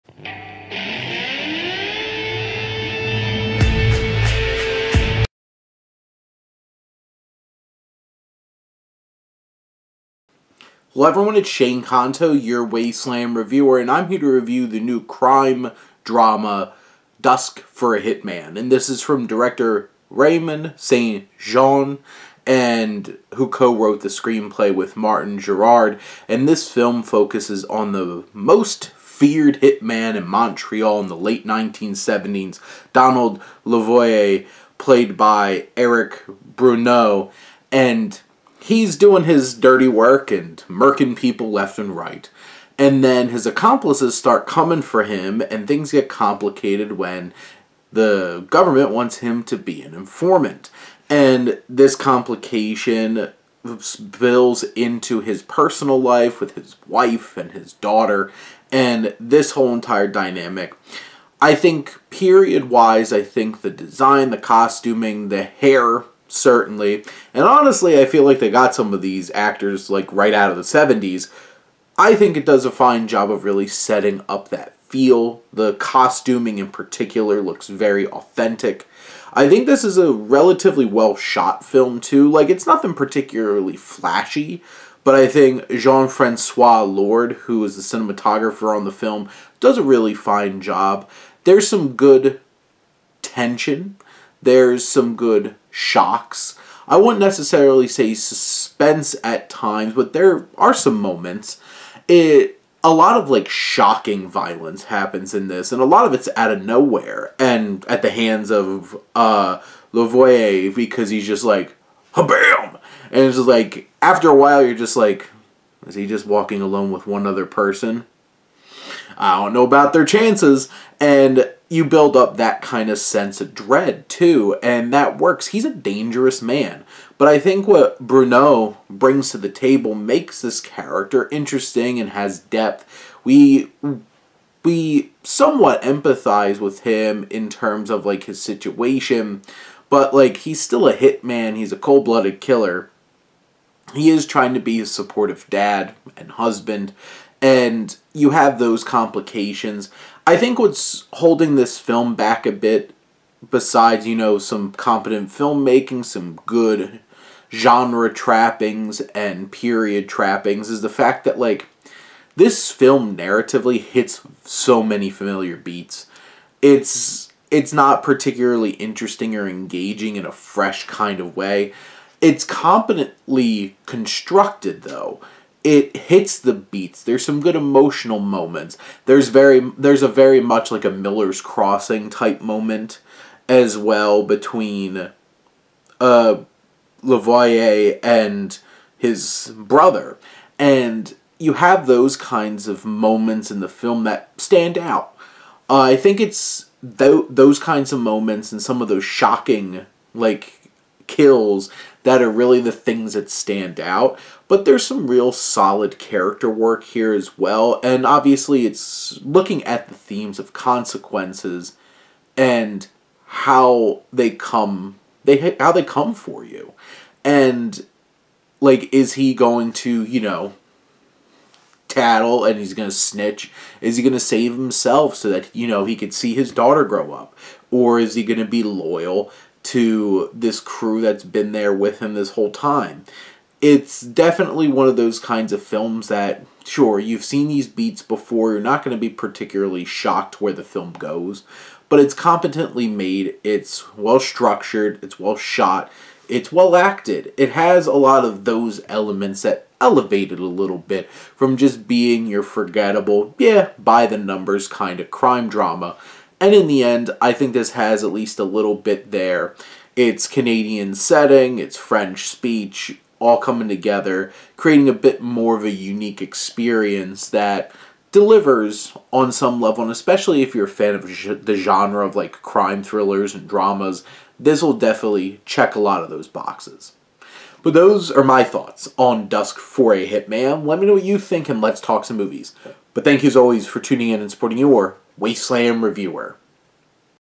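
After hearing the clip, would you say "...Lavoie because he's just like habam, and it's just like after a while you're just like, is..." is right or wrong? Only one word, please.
right.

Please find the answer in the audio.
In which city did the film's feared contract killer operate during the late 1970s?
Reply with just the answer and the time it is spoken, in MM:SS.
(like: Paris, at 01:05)
Montreal, at 00:30.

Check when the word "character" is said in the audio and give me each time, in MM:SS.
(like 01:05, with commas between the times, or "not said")
02:10, 03:25.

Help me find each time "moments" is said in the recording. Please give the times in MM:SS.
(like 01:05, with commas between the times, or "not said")
01:40, 02:58, 03:02, 03:12, 03:17.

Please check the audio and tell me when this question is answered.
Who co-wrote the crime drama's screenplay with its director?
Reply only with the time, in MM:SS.
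00:24.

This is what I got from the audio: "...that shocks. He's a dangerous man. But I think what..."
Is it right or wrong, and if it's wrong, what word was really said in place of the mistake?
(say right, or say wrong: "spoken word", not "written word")
wrong: "works", not "shocks".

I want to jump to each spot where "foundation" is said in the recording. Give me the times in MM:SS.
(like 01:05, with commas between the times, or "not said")
not said.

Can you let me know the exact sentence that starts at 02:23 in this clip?
He is trying to be a supportive dad and husband and you have those complications.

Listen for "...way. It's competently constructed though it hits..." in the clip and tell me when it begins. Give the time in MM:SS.
02:51.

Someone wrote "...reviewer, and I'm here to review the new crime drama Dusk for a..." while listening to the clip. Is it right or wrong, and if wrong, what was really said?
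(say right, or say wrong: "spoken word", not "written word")
right.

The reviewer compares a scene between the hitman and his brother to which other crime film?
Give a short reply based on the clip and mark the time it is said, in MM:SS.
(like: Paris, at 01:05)
Miller's Crossing, at 03:00.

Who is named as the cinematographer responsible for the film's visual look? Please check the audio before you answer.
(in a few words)
Jean-Francois Lord.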